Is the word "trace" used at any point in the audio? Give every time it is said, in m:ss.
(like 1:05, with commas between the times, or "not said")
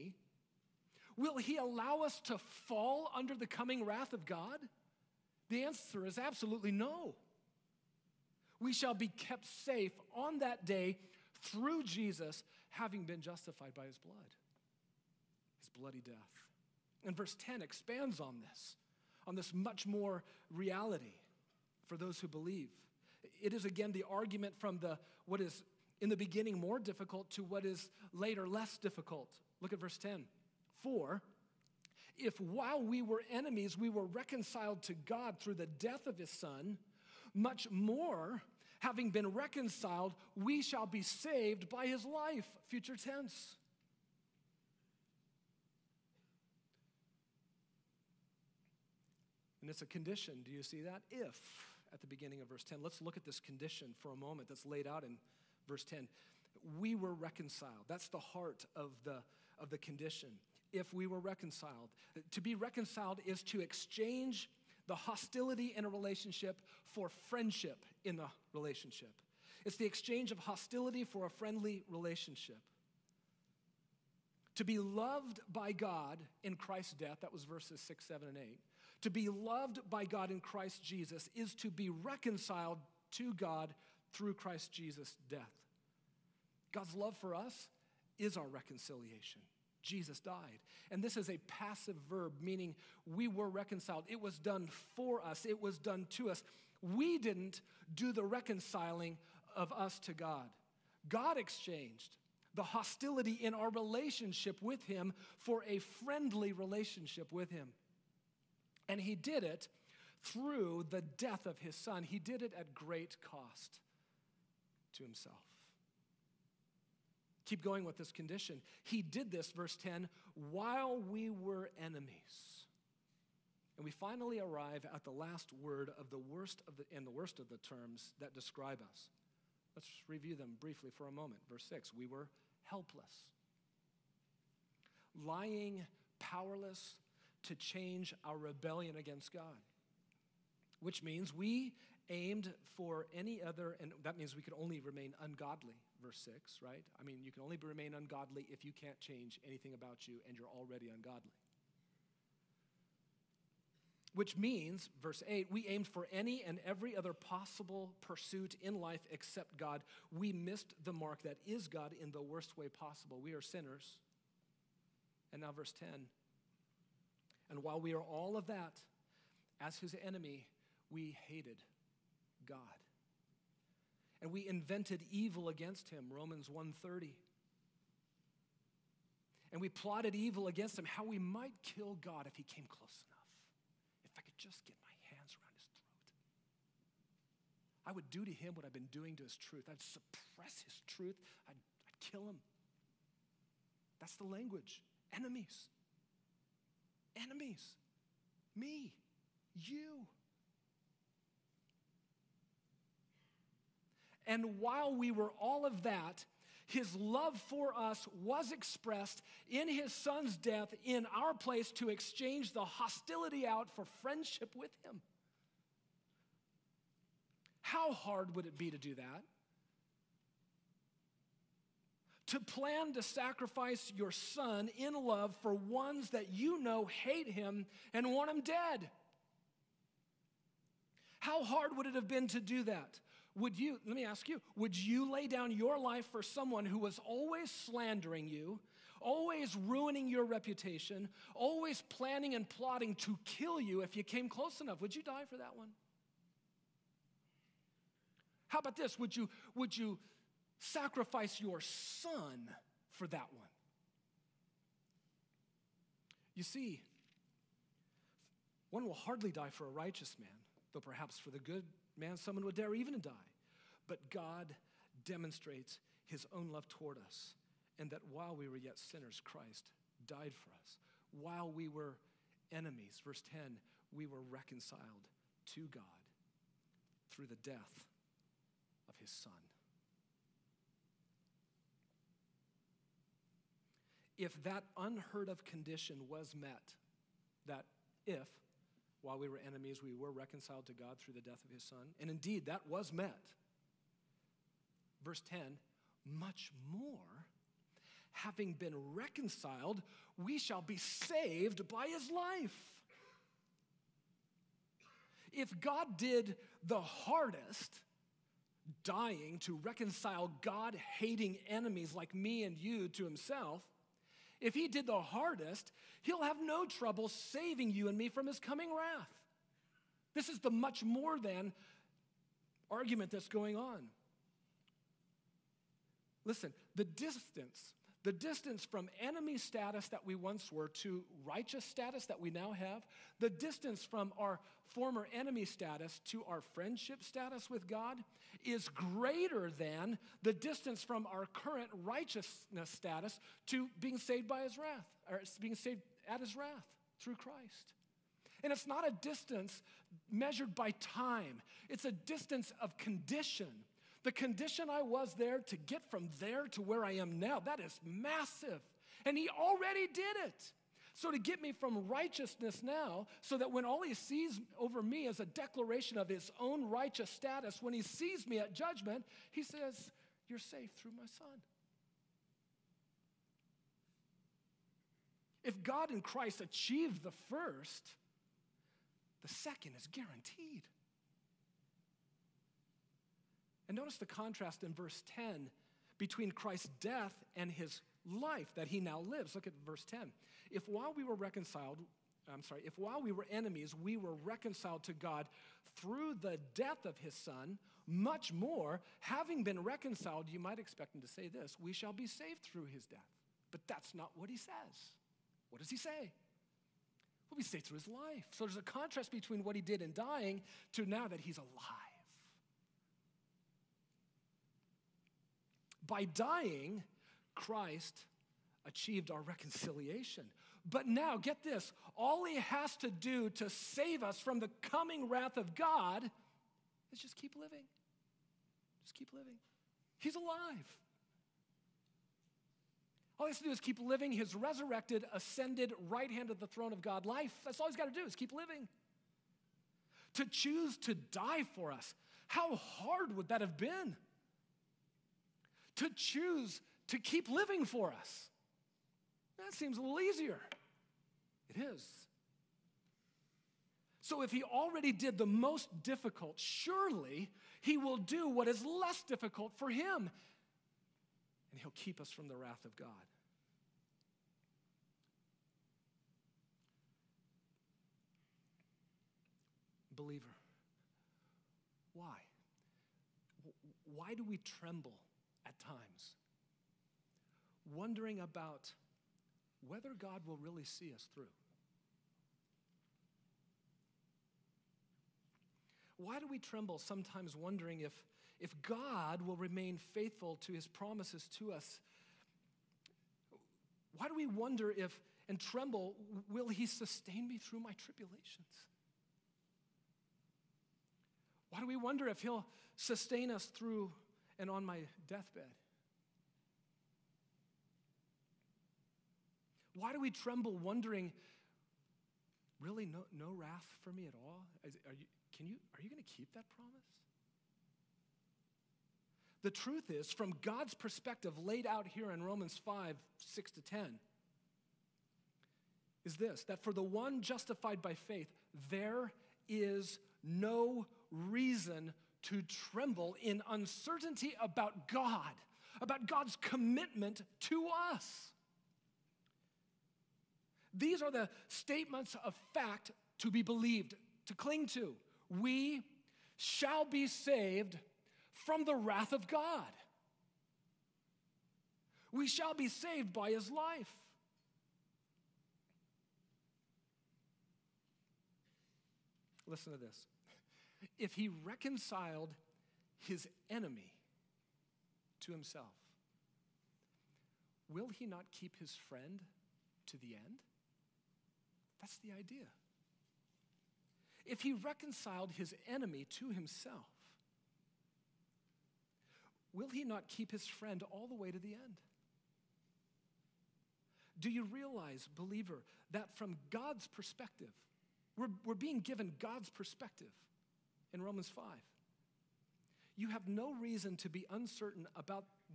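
not said.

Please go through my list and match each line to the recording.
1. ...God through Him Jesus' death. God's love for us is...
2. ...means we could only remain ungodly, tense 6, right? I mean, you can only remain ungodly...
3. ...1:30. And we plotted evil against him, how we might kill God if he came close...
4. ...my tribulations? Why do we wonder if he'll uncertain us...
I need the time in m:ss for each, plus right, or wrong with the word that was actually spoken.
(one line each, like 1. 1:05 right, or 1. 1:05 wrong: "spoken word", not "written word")
1. 1:23 wrong: "Christ", not "Him"
2. 2:24 wrong: "verse", not "tense"
3. 2:56 right
4. 8:17 wrong: "sustain", not "uncertain".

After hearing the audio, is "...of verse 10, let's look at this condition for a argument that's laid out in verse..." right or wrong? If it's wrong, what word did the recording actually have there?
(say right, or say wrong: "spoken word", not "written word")
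wrong: "moment", not "argument".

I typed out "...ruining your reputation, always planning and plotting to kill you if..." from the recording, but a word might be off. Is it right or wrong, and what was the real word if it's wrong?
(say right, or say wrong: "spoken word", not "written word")
right.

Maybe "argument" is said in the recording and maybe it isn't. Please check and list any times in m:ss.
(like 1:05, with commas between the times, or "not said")
0:24, 5:22.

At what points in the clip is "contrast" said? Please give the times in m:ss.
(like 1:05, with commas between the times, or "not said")
6:24, 6:48.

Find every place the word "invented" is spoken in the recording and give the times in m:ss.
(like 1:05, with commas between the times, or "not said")
2:54.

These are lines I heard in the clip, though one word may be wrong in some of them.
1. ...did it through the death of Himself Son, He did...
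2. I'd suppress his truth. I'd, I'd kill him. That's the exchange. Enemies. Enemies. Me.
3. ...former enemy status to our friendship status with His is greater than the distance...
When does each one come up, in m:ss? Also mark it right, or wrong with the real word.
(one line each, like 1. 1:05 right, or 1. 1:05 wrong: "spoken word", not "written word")
1. 1:49 wrong: "His", not "Himself"
2. 3:09 wrong: "language", not "exchange"
3. 5:34 wrong: "God", not "His".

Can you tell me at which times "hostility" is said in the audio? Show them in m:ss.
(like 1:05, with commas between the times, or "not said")
1:04, 1:10, 1:42, 3:32.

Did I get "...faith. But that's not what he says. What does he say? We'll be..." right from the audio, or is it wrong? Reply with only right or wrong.
wrong.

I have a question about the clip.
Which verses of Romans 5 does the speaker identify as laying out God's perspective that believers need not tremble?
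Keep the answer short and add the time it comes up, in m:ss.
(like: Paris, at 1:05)
Romans 5:6-10, at 8:42.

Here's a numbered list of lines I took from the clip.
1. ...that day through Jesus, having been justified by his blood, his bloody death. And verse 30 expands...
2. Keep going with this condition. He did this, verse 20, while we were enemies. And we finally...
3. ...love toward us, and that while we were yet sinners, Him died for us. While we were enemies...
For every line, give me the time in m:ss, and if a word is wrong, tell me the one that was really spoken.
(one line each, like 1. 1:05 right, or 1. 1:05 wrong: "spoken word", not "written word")
1. 0:10 wrong: "10", not "30"
2. 1:57 wrong: "10", not "20"
3. 4:26 wrong: "Christ", not "Him".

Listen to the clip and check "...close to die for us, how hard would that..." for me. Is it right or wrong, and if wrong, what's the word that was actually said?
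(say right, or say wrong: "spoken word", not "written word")
wrong: "choose", not "close".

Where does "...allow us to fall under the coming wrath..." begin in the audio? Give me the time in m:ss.
0:01.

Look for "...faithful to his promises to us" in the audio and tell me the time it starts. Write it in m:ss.
8:09.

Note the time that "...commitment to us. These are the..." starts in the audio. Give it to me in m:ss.
8:56.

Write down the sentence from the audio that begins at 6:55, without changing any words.
By dying, Christ achieved our reconciliation.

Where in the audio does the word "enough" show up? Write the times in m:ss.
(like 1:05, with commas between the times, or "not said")
3:03, 4:04.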